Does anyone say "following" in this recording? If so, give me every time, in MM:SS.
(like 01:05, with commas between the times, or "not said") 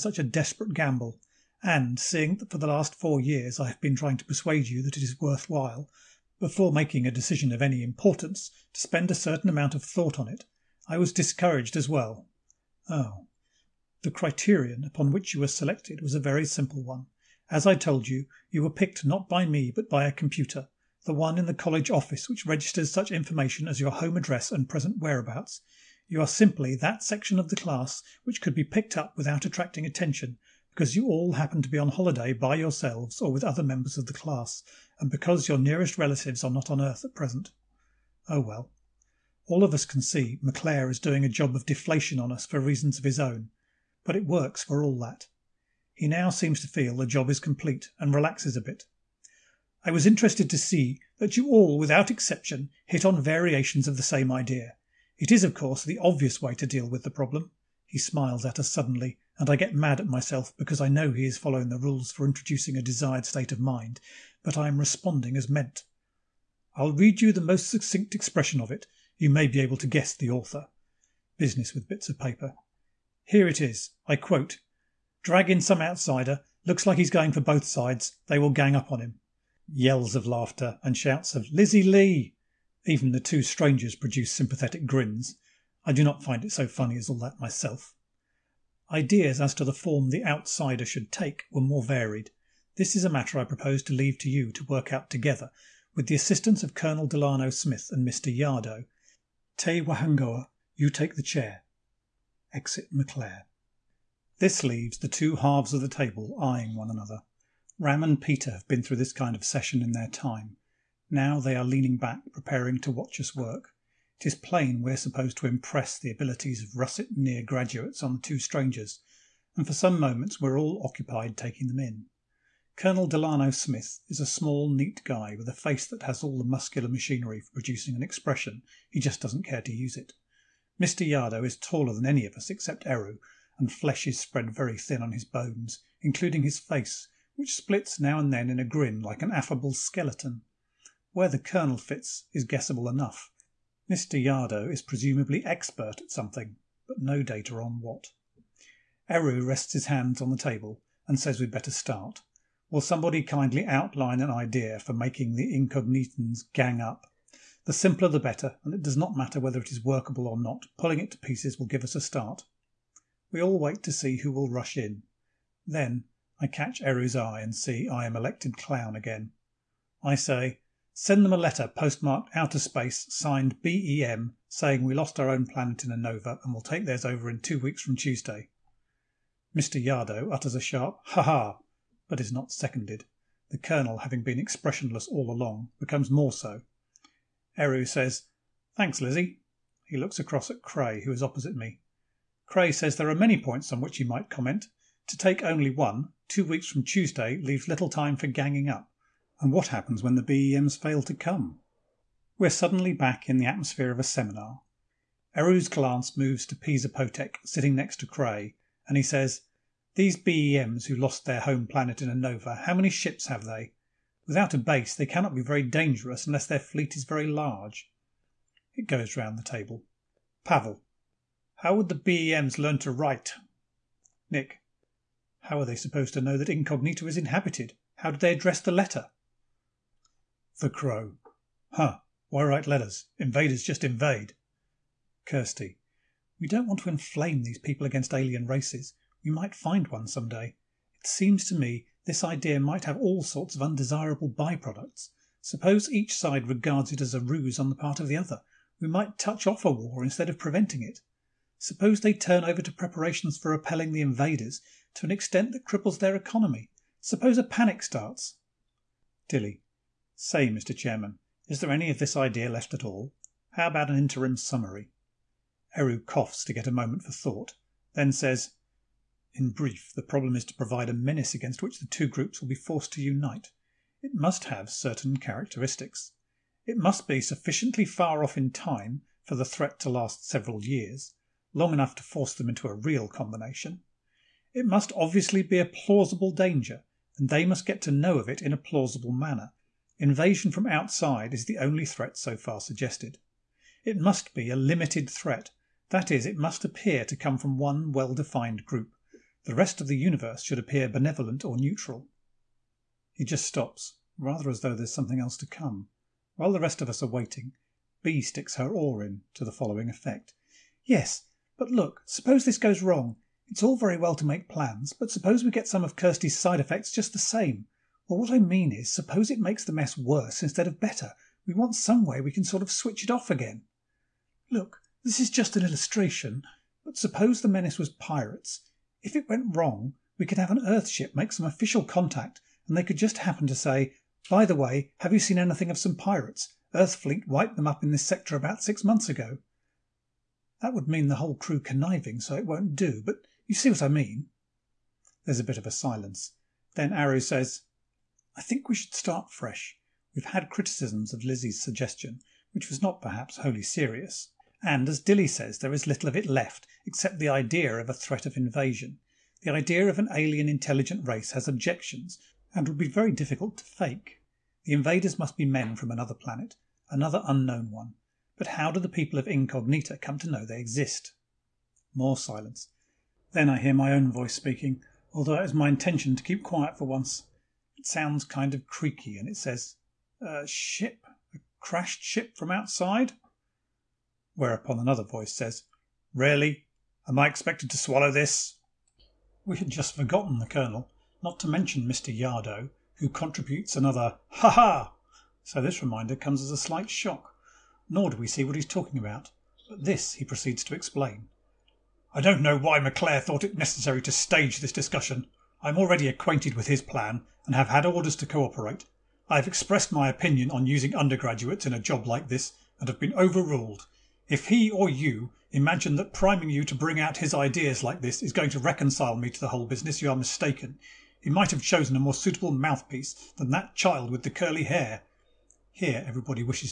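01:01, 05:09.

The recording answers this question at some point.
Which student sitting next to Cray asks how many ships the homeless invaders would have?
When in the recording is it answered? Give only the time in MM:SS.
03:26.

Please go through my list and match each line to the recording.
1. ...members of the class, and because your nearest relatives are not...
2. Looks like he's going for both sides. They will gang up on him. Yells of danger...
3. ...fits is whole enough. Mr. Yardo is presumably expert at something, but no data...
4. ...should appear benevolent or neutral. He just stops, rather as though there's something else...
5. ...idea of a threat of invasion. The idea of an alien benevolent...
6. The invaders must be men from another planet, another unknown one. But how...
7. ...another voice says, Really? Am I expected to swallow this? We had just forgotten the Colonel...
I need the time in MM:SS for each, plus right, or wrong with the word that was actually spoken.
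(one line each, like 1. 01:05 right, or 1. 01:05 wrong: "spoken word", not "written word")
1. 00:33 right
2. 01:16 wrong: "laughter", not "danger"
3. 02:21 wrong: "guessable", not "whole"
4. 05:00 right
5. 05:57 wrong: "intelligent", not "benevolent"
6. 06:04 right
7. 06:24 right.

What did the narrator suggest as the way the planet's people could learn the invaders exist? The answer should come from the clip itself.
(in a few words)
A crashed ship.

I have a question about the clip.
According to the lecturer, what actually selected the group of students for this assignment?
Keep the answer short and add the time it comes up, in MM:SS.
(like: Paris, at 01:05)
A computer, at 00:20.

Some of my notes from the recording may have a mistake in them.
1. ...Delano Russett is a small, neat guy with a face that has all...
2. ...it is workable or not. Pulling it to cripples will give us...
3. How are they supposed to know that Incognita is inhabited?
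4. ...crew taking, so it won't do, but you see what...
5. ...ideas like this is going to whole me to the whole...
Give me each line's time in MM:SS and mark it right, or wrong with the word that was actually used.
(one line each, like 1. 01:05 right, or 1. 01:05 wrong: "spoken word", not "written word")
1. 02:03 wrong: "Smith", not "Russett"
2. 02:39 wrong: "pieces", not "cripples"
3. 03:45 right
4. 05:41 wrong: "conniving", not "taking"
5. 06:57 wrong: "reconcile", not "whole".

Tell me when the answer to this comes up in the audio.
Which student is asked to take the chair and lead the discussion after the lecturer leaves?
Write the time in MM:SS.
01:39.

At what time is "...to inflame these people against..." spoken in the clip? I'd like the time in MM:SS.
03:56.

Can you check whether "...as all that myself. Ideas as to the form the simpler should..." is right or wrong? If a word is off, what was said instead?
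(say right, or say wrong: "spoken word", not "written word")
wrong: "outsider", not "simpler".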